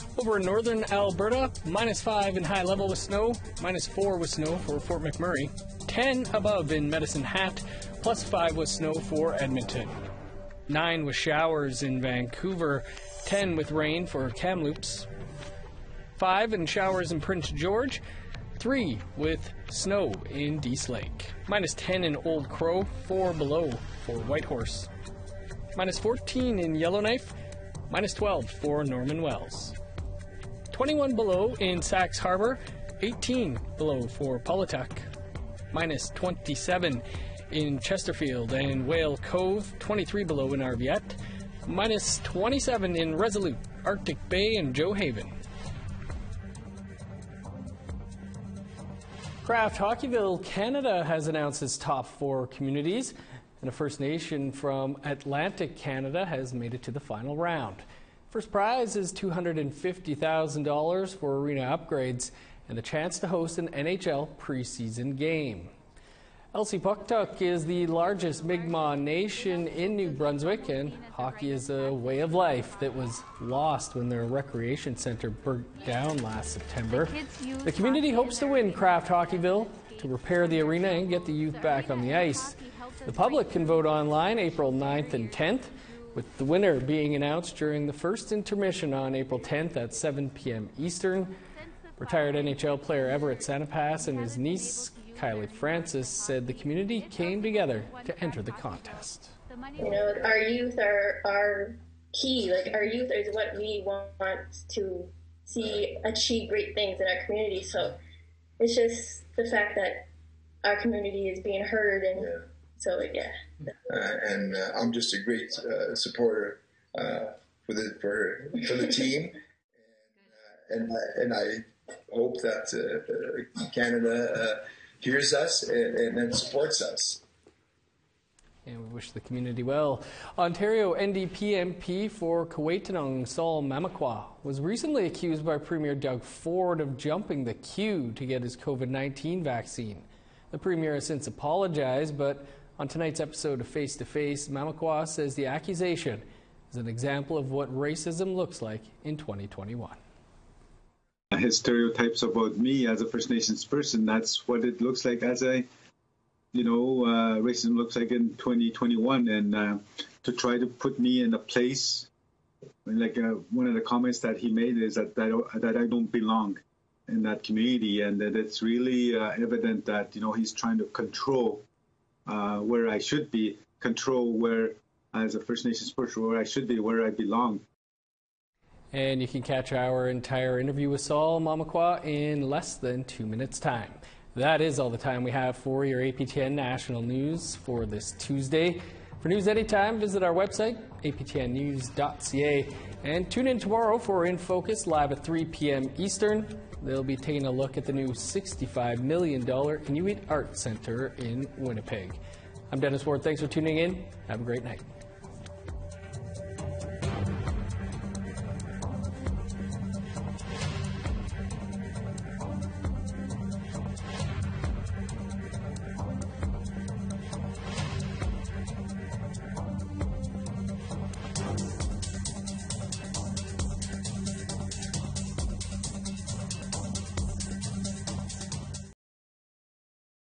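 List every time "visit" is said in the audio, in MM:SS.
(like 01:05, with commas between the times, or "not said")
03:09.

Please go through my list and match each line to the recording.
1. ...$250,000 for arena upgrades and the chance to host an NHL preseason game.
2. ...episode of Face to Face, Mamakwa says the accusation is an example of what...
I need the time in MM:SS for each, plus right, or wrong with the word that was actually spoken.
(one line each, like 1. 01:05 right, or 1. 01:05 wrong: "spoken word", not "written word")
1. 00:59 right
2. 02:23 right.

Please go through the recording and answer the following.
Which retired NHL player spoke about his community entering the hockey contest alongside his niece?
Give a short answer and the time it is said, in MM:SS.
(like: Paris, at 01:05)
Everett Sanipass, at 01:33.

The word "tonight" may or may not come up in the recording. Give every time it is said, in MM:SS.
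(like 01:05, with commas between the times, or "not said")
02:22.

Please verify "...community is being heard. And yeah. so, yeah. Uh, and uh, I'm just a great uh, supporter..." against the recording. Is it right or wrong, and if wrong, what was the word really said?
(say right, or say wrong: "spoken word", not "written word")
right.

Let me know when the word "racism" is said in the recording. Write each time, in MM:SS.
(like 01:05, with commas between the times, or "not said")
02:27, 02:37.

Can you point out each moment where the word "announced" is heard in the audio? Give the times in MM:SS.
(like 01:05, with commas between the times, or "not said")
00:51, 01:27.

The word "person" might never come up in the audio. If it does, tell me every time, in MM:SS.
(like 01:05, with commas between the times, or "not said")
02:33, 02:55.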